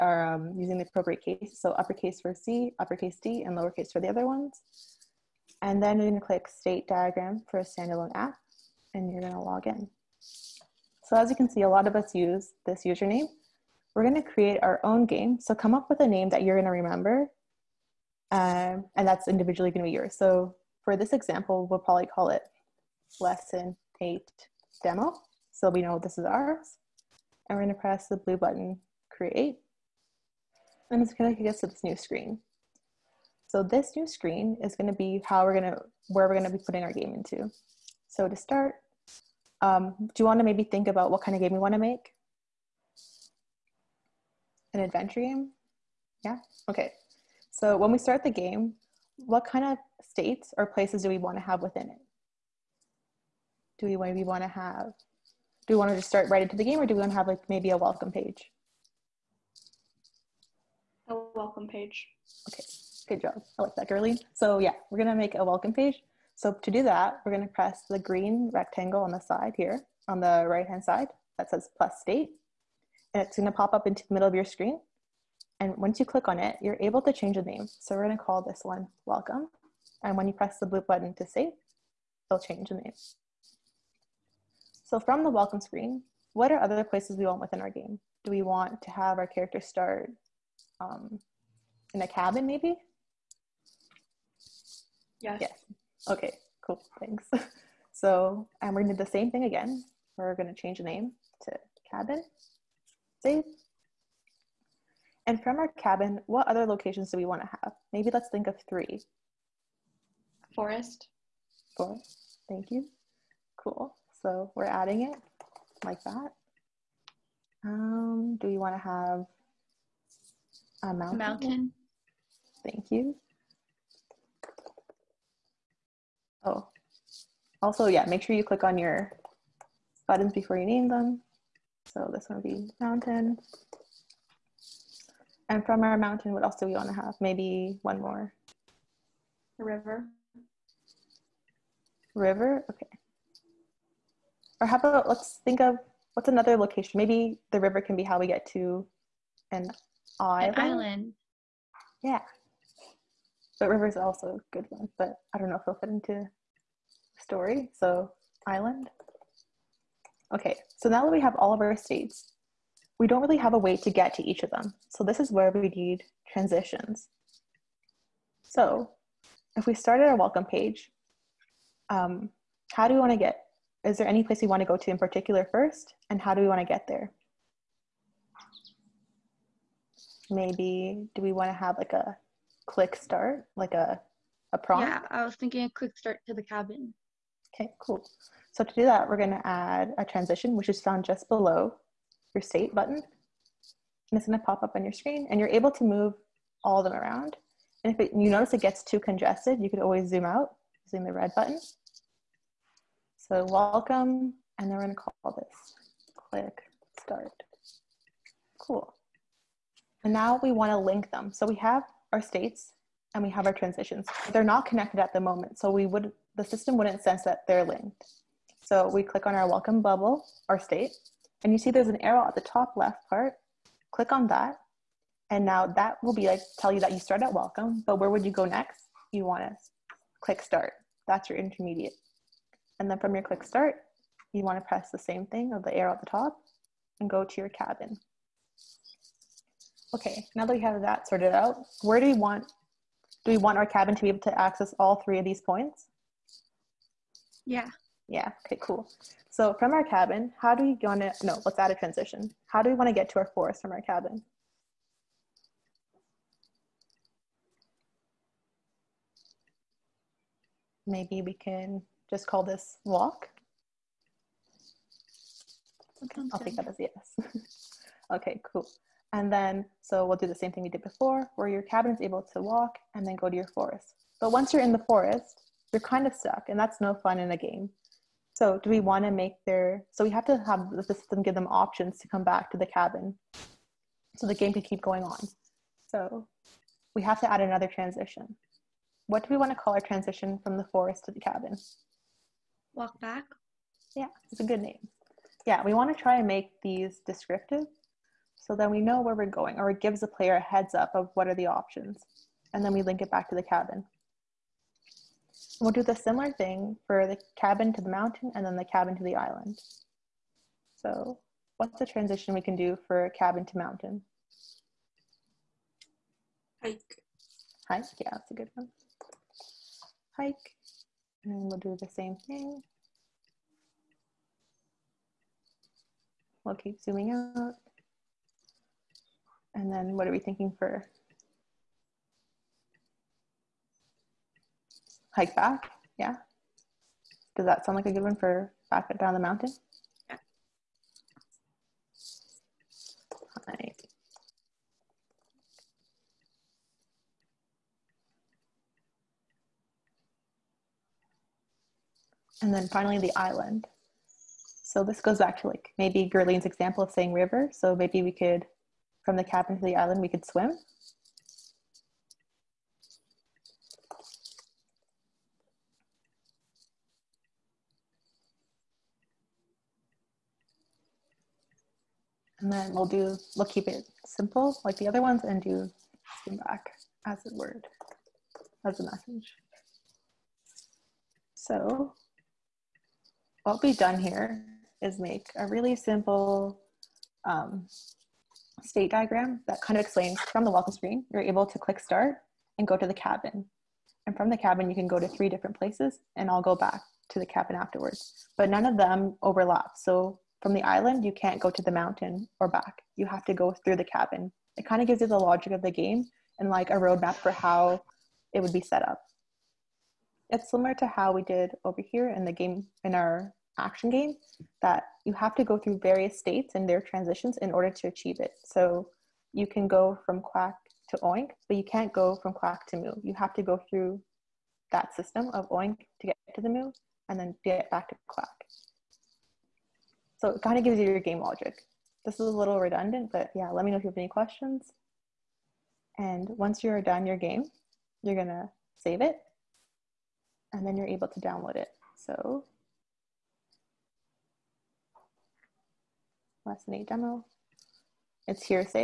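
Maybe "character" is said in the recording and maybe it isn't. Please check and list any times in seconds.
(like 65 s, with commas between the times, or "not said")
89 s.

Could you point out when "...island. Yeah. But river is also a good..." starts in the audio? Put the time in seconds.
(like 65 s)
150 s.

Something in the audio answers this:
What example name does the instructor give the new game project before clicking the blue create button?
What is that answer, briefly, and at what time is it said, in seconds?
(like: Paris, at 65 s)
lesson eight demo, at 23 s.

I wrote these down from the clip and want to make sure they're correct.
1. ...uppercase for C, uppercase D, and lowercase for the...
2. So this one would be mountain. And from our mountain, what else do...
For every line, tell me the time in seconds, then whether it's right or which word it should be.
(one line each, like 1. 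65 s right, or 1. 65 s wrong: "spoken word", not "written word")
1. 1 s right
2. 131 s right.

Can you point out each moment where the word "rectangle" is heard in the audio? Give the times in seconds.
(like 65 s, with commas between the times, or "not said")
68 s.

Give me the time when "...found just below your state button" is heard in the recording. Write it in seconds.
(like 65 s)
190 s.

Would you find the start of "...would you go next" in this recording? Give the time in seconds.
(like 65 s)
228 s.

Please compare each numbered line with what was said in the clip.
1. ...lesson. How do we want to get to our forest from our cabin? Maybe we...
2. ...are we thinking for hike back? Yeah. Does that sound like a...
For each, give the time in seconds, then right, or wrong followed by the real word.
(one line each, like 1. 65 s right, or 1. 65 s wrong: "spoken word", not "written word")
1. 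251 s wrong: "transition", not "lesson"
2. 330 s right.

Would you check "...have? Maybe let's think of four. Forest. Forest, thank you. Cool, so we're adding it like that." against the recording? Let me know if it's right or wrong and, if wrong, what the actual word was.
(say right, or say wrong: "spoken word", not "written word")
wrong: "three", not "four".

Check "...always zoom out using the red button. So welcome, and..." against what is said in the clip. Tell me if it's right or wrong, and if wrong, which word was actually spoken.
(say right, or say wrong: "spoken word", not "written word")
right.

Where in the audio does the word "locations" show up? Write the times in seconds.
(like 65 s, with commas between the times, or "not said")
106 s, 146 s.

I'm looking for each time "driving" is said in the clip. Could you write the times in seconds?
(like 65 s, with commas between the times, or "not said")
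not said.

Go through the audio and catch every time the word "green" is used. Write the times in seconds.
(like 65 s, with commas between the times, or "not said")
67 s.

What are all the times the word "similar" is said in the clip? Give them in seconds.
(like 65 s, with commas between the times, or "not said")
305 s, 410 s.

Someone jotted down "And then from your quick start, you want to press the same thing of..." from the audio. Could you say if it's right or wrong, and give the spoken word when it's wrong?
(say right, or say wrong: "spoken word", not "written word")
wrong: "click", not "quick".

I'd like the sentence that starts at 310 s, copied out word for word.
So what's the transition we can do for cabin to mountain?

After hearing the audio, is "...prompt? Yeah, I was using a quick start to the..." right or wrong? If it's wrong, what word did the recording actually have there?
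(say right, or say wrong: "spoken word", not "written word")
wrong: "thinking", not "using".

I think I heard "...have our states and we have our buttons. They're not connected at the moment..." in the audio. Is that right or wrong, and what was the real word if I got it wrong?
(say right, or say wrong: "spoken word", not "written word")
wrong: "transitions", not "buttons".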